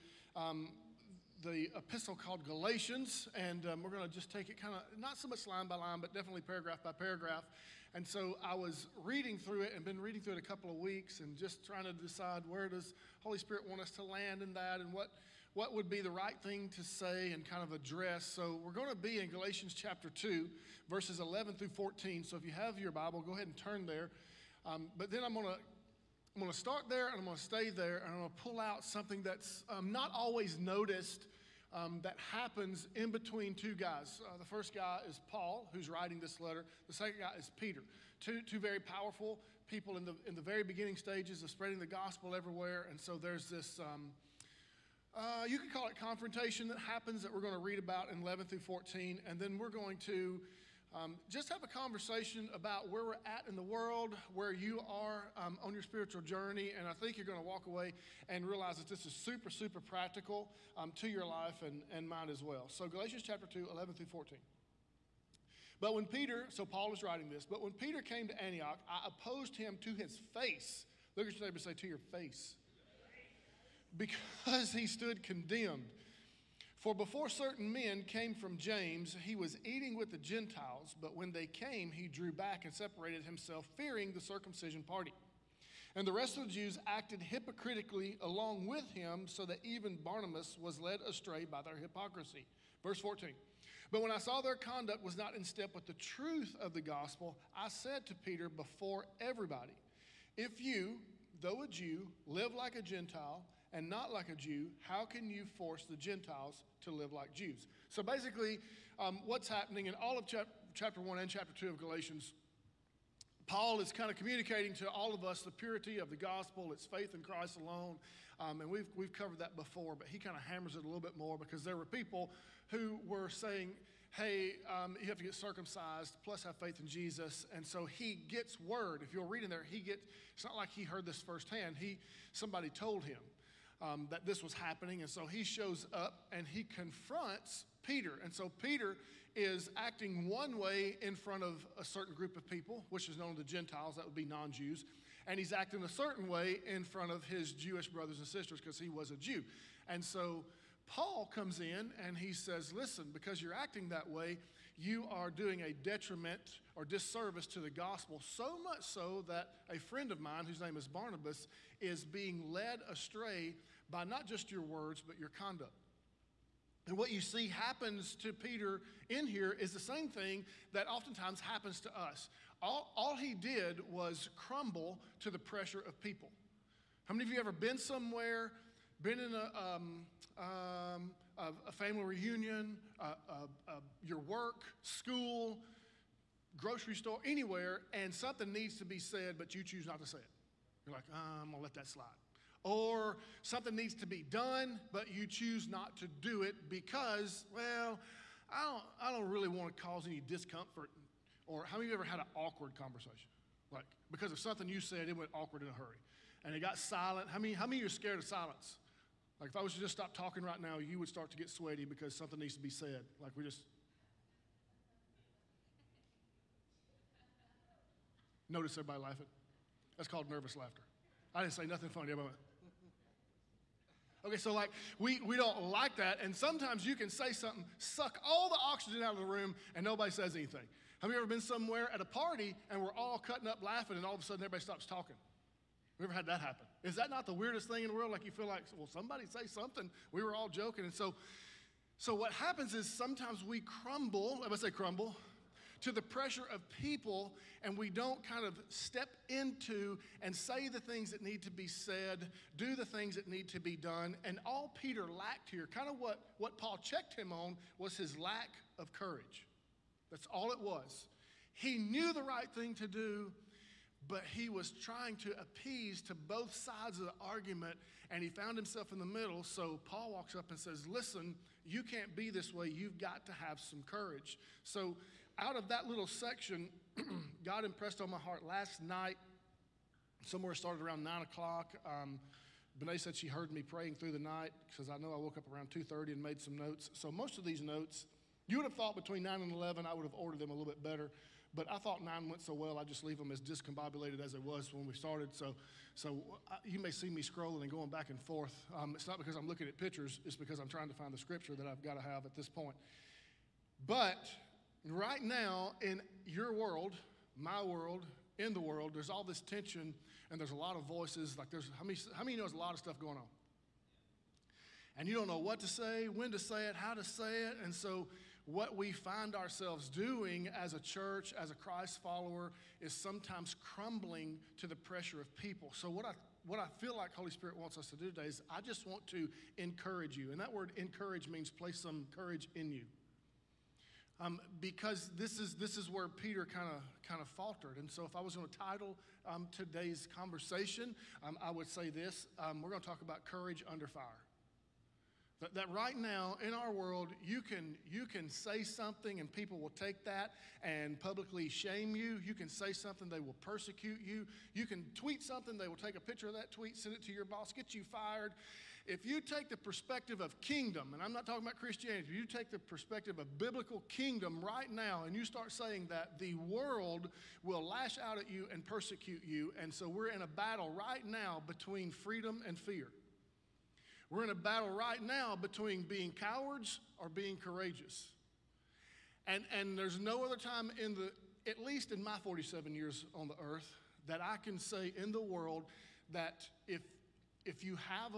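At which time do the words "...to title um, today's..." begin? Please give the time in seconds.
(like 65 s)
338 s.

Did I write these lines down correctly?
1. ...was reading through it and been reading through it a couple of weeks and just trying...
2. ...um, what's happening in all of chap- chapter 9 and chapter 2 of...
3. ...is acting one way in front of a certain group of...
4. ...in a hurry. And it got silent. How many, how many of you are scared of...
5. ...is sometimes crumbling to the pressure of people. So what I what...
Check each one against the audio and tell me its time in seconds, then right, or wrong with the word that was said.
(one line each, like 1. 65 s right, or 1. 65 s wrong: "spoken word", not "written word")
1. 8 s right
2. 108 s wrong: "1", not "9"
3. 139 s right
4. 205 s right
5. 322 s right.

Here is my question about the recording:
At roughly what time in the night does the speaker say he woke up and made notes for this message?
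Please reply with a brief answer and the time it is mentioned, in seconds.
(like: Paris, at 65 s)
2:30, at 285 s.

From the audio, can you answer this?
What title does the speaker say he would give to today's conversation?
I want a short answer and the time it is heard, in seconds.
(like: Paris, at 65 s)
Courage under fire, at 343 s.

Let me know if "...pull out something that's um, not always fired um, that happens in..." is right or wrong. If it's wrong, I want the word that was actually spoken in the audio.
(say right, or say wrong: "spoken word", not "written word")
wrong: "noticed", not "fired".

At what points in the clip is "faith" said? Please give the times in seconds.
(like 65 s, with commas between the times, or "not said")
116 s, 126 s.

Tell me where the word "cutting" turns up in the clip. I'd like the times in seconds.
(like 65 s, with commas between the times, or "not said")
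233 s.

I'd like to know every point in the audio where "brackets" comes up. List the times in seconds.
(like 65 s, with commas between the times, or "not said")
not said.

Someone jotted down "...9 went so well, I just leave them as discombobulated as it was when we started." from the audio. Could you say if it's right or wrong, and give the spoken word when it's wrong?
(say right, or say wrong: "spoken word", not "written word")
right.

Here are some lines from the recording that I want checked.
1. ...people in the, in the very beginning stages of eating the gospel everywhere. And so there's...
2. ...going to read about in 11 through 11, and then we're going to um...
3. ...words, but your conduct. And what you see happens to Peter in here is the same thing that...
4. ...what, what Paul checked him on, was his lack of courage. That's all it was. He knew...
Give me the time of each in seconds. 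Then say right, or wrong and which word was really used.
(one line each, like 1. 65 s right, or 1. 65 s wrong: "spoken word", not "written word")
1. 39 s wrong: "spreading", not "eating"
2. 47 s wrong: "14", not "11"
3. 164 s right
4. 255 s right.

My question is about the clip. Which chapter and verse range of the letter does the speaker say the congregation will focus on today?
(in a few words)
Chapter 2, verses 11-14.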